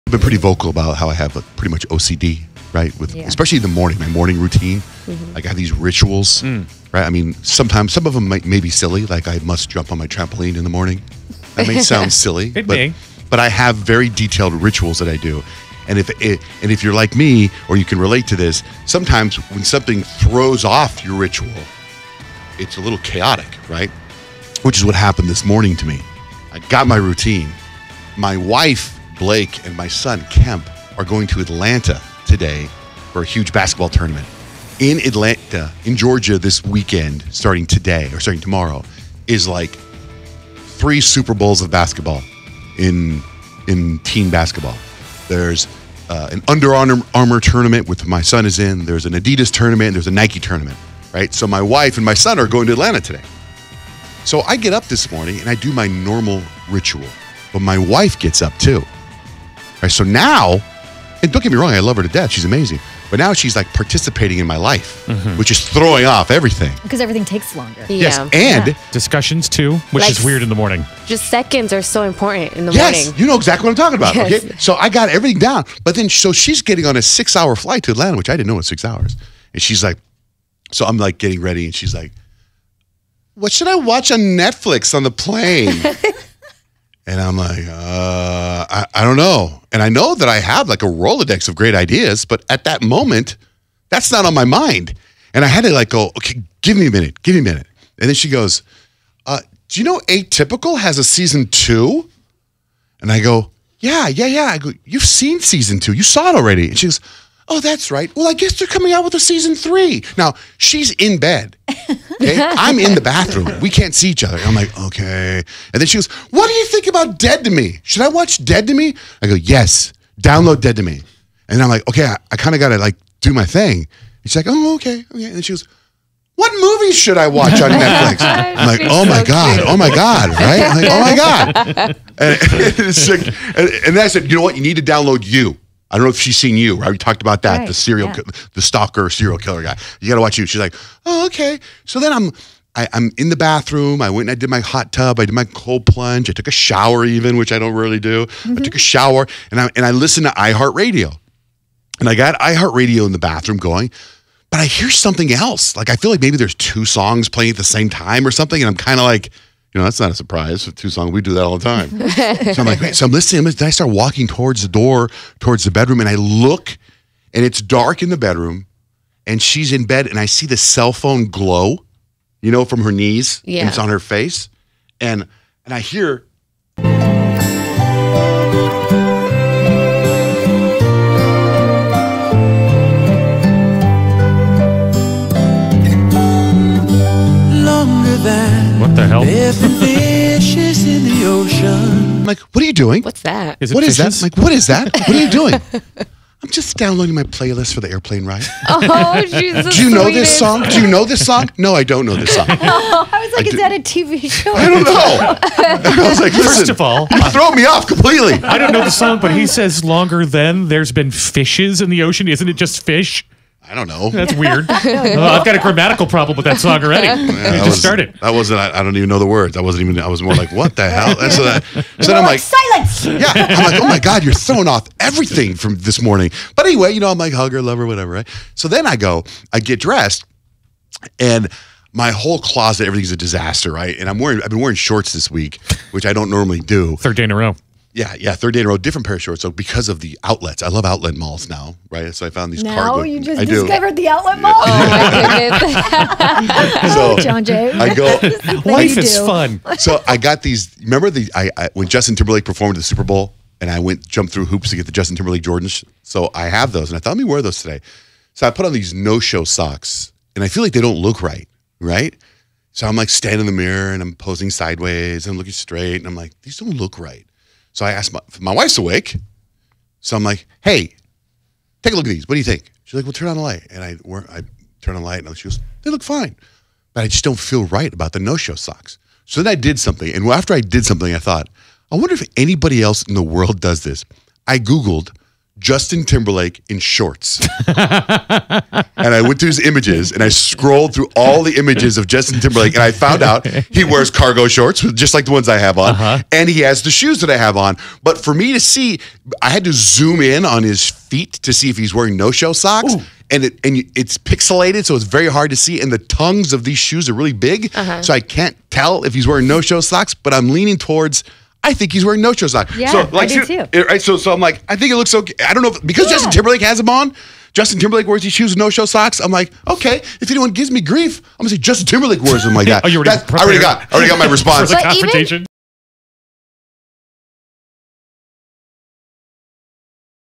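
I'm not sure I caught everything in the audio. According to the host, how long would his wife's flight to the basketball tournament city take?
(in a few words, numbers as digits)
6 hours.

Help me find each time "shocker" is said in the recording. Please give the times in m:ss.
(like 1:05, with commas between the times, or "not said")
not said.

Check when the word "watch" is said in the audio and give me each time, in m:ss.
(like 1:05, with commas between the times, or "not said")
1:23, 1:58, 2:07, 2:20.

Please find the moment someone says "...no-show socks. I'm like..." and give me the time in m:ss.
5:18.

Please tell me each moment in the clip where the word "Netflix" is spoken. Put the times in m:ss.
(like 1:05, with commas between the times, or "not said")
1:24, 2:07.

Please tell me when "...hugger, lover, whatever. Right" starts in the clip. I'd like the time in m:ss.
3:47.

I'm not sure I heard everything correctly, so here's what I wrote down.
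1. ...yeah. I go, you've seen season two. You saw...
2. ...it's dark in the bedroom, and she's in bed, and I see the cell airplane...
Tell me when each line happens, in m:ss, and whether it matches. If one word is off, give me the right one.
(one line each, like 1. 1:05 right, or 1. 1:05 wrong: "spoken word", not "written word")
1. 1:44 right
2. 2:47 wrong: "phone", not "airplane".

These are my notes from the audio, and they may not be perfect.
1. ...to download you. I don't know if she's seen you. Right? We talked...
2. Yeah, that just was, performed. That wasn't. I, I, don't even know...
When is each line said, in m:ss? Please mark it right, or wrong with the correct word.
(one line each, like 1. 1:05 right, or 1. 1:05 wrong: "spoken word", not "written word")
1. 2:14 right
2. 3:37 wrong: "started", not "performed".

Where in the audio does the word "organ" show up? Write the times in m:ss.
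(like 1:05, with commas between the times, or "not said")
not said.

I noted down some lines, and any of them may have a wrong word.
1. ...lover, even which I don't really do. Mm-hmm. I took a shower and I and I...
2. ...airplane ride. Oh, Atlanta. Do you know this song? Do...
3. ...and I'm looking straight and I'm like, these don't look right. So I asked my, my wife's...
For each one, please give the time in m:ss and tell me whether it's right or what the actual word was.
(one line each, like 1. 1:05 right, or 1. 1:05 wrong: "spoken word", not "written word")
1. 2:26 wrong: "shower", not "lover"
2. 3:17 wrong: "Jesus", not "Atlanta"
3. 4:25 right.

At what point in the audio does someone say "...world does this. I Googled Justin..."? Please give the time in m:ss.
4:43.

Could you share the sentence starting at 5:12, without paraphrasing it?
Yeah, so, like, I do too.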